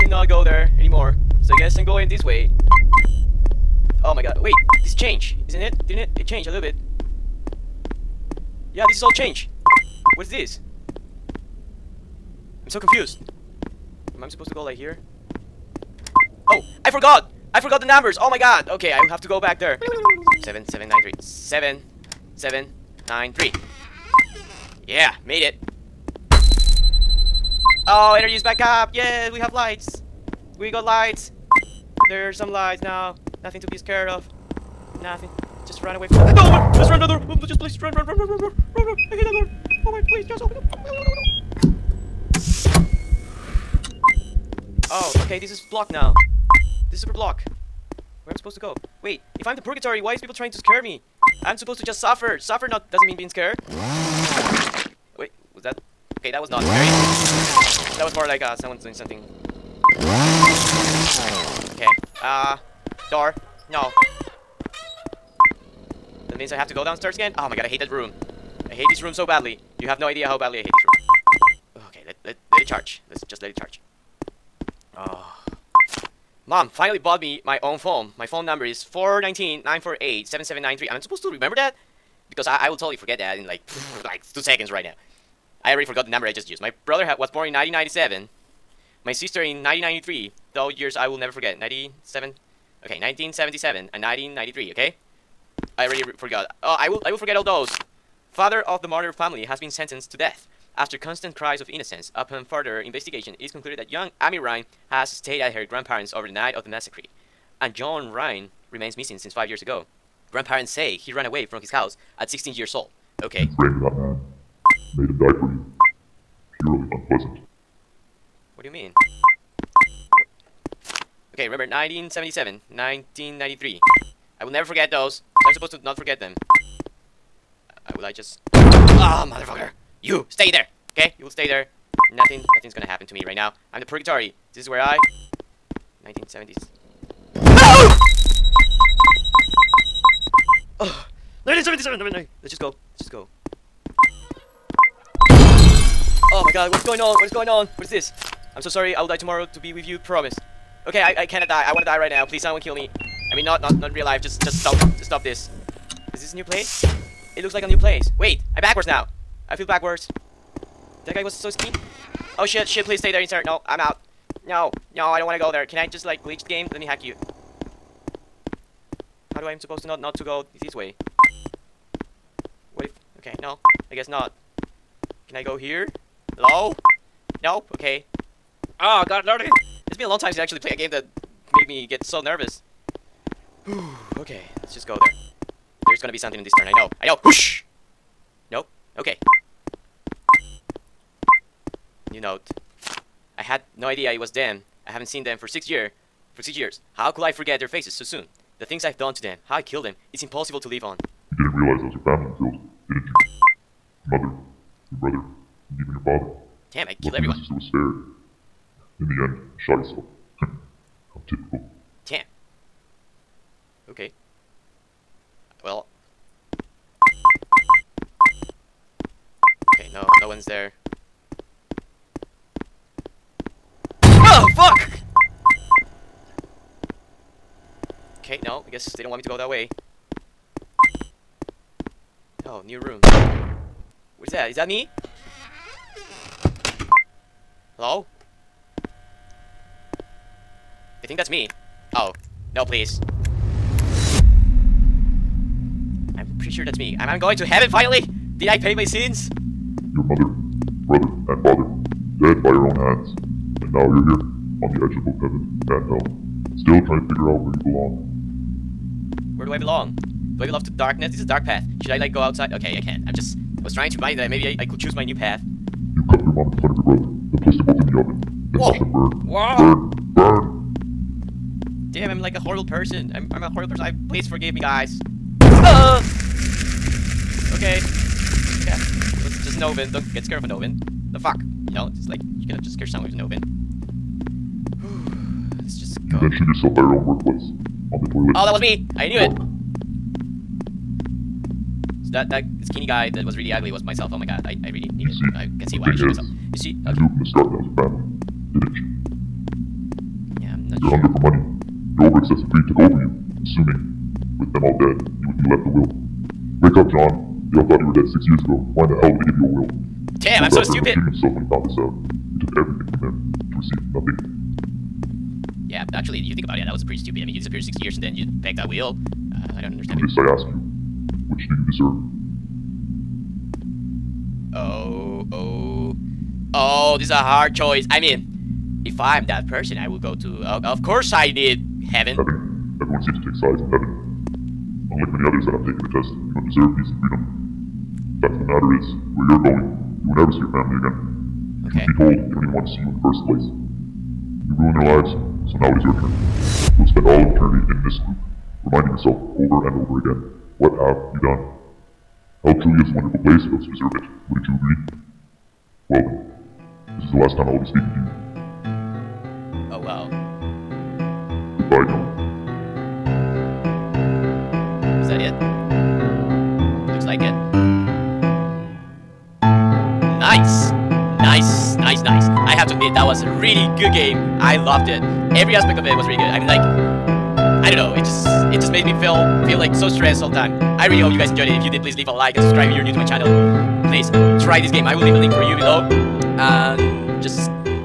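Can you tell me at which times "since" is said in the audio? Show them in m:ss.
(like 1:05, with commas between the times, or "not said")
1:49, 3:00.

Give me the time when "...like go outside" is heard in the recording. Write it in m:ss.
4:21.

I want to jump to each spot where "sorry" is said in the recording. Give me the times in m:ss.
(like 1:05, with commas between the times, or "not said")
2:28.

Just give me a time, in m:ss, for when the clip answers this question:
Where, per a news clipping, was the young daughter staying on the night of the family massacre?
1:45.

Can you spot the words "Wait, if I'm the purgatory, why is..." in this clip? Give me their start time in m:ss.
0:49.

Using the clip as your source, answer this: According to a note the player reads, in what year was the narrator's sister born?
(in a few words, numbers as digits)
1993.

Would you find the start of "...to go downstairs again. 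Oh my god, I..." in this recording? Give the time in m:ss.
1:06.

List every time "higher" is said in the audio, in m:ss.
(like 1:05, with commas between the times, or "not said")
not said.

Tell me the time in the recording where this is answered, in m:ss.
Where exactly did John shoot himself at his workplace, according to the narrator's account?
4:47.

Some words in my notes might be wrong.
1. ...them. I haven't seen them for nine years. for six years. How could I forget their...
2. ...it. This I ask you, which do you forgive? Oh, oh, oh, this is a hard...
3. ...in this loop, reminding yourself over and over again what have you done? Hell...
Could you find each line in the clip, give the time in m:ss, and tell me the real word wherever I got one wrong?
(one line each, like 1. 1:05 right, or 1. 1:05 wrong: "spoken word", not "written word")
1. 3:14 wrong: "six", not "nine"
2. 5:19 wrong: "deserve", not "forgive"
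3. 5:47 right.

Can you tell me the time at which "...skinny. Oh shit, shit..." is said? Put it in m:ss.
2:41.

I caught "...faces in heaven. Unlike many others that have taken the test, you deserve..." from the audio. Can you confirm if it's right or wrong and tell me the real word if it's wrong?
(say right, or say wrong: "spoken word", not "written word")
wrong: "sides", not "faces".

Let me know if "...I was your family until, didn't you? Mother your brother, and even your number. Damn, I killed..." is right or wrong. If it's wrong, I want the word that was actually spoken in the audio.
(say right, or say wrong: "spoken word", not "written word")
wrong: "father", not "number".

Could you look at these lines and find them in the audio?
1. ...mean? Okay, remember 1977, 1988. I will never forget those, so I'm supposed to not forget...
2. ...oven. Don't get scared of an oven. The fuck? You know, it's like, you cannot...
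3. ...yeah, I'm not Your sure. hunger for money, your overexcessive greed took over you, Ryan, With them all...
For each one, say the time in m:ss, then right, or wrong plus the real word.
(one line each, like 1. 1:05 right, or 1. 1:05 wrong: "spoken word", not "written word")
1. 1:58 wrong: "1993", not "1988"
2. 4:39 right
3. 4:58 wrong: "Assuming", not "Ryan".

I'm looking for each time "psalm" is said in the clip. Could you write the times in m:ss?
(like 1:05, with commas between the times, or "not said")
not said.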